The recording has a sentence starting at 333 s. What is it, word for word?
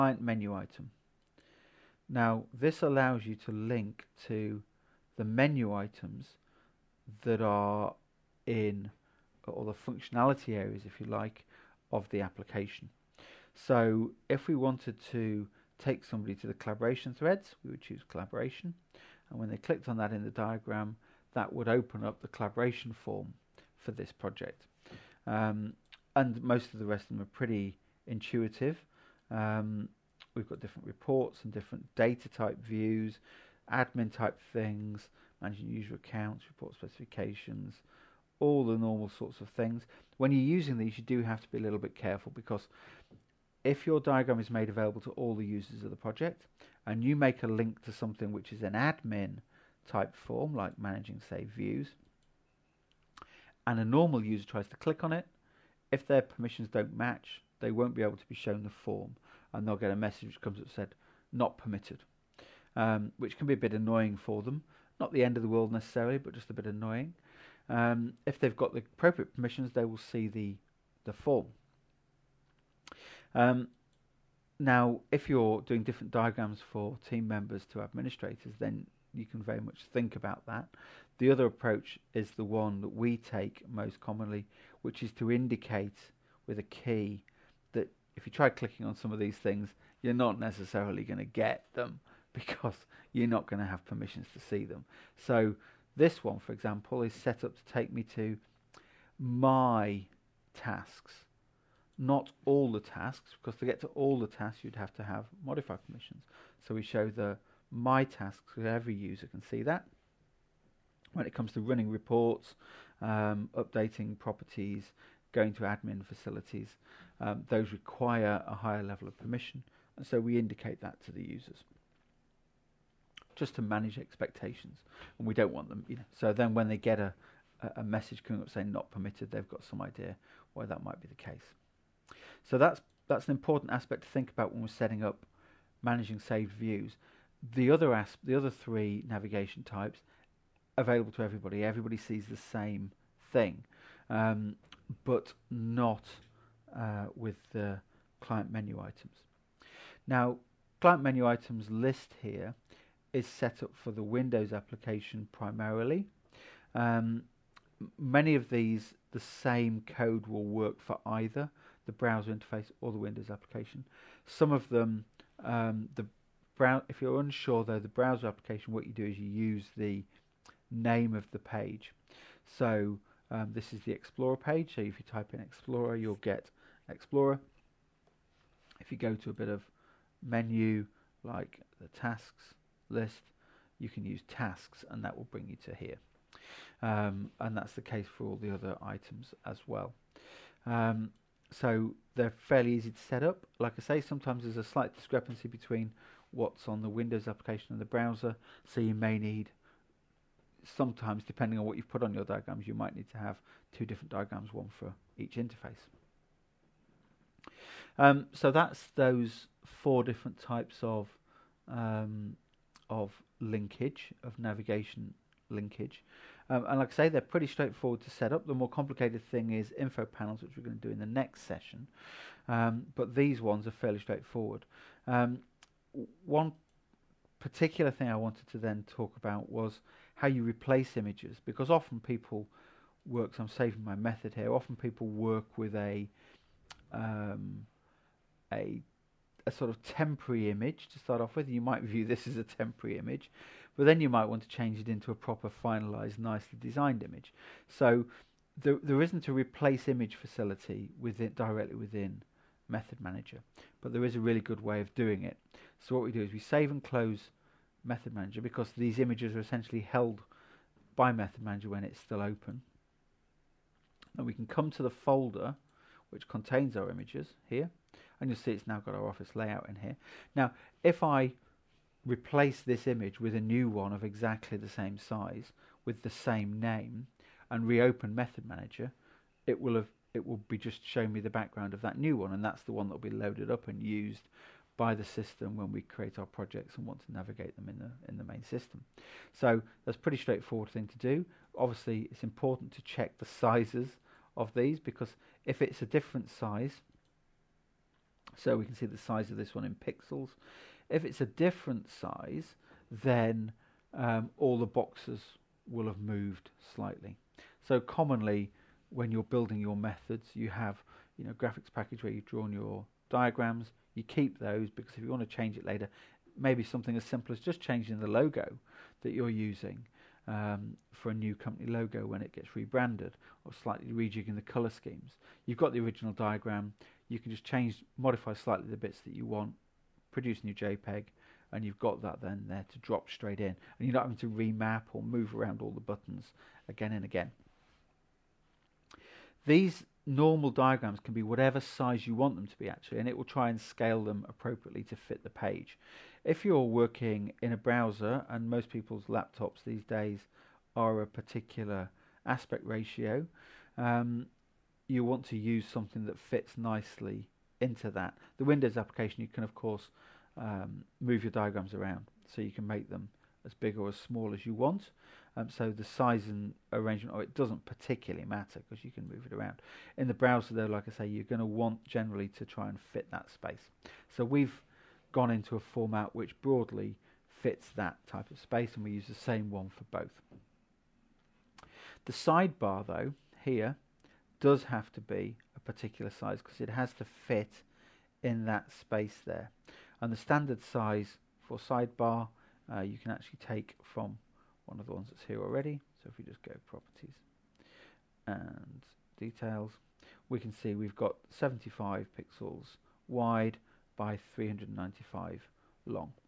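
And you're not having to remap or move around all the buttons again and again.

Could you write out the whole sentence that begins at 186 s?
Um, and that's the case for all the other items as well.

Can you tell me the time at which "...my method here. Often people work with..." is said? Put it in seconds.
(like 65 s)
233 s.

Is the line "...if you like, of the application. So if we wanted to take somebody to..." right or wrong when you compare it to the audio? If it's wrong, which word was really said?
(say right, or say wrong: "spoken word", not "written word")
right.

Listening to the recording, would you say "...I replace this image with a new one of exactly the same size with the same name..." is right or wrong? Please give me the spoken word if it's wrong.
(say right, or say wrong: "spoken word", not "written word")
right.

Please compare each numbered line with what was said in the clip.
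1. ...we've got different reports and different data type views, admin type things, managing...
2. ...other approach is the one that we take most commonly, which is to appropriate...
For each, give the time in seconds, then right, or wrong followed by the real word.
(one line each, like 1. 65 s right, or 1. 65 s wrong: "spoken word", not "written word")
1. 30 s right
2. 81 s wrong: "indicate", not "appropriate".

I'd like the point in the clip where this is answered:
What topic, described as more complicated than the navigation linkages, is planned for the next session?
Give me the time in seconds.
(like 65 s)
219 s.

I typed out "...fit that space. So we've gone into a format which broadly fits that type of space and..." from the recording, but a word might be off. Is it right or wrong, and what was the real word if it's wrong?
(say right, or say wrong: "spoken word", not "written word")
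right.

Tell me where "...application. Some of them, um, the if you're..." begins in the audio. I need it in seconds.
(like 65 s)
163 s.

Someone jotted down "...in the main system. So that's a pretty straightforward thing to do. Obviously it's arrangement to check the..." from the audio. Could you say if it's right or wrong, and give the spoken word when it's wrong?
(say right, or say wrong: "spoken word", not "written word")
wrong: "important", not "arrangement".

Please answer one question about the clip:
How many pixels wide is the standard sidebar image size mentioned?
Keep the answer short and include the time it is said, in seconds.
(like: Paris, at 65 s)
75, at 401 s.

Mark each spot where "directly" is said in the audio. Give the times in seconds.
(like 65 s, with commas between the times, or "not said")
251 s.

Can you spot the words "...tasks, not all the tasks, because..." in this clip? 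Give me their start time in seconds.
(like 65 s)
100 s.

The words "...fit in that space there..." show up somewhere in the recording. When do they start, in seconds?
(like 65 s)
387 s.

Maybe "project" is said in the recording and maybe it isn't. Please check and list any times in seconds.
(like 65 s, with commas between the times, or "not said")
24 s, 45 s, 286 s.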